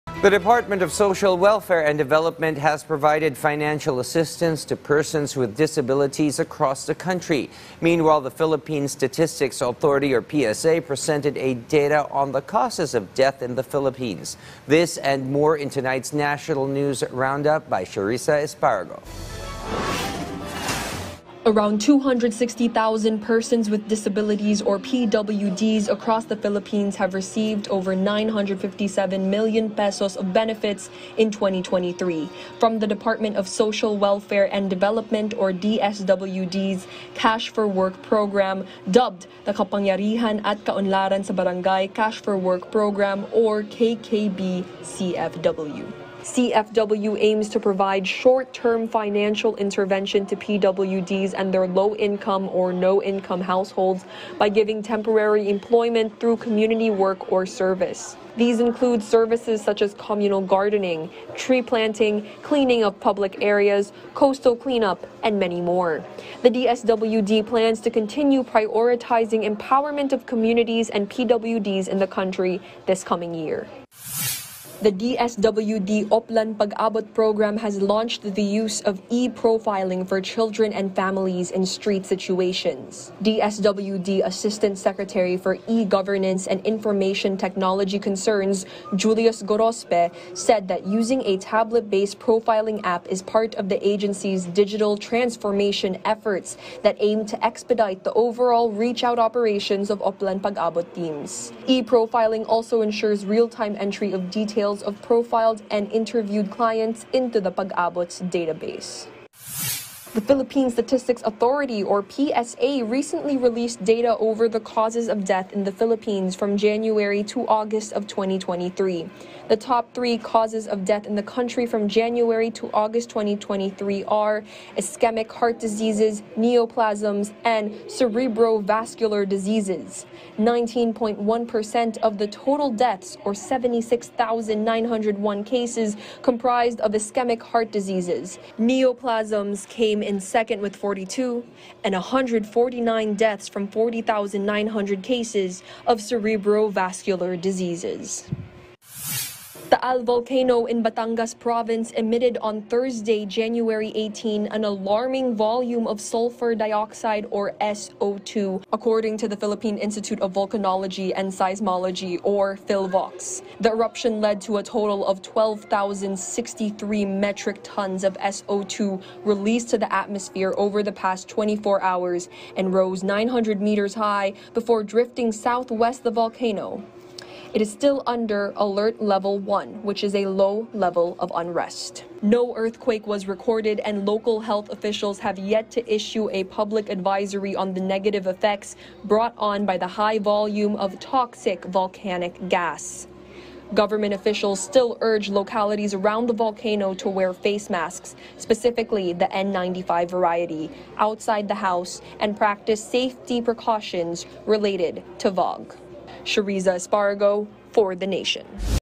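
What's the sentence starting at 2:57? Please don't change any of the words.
It is still under alert level 1, which is a low level of unrest.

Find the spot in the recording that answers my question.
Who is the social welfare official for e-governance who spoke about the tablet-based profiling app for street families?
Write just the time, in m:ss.
1:28.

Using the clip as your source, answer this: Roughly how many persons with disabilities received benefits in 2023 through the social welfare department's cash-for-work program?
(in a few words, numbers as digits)
260,000.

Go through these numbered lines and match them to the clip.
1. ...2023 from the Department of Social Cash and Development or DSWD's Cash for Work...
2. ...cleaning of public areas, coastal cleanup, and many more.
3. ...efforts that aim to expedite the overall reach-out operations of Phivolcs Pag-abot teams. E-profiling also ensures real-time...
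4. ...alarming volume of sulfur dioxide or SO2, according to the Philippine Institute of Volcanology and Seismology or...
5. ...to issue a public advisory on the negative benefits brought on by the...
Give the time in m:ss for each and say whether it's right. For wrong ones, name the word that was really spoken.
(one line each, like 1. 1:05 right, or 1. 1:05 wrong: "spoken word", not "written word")
1. 0:31 wrong: "Welfare", not "Cash"
2. 1:02 right
3. 1:36 wrong: "Oplan", not "Phivolcs"
4. 2:34 right
5. 3:05 wrong: "effects", not "benefits".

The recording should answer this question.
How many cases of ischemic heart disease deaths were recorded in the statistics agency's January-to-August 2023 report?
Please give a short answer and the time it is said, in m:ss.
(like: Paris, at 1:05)
76,901, at 2:13.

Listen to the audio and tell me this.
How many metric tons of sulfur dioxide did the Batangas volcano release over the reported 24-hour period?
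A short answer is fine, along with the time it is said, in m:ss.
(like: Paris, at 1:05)
12,063, at 2:45.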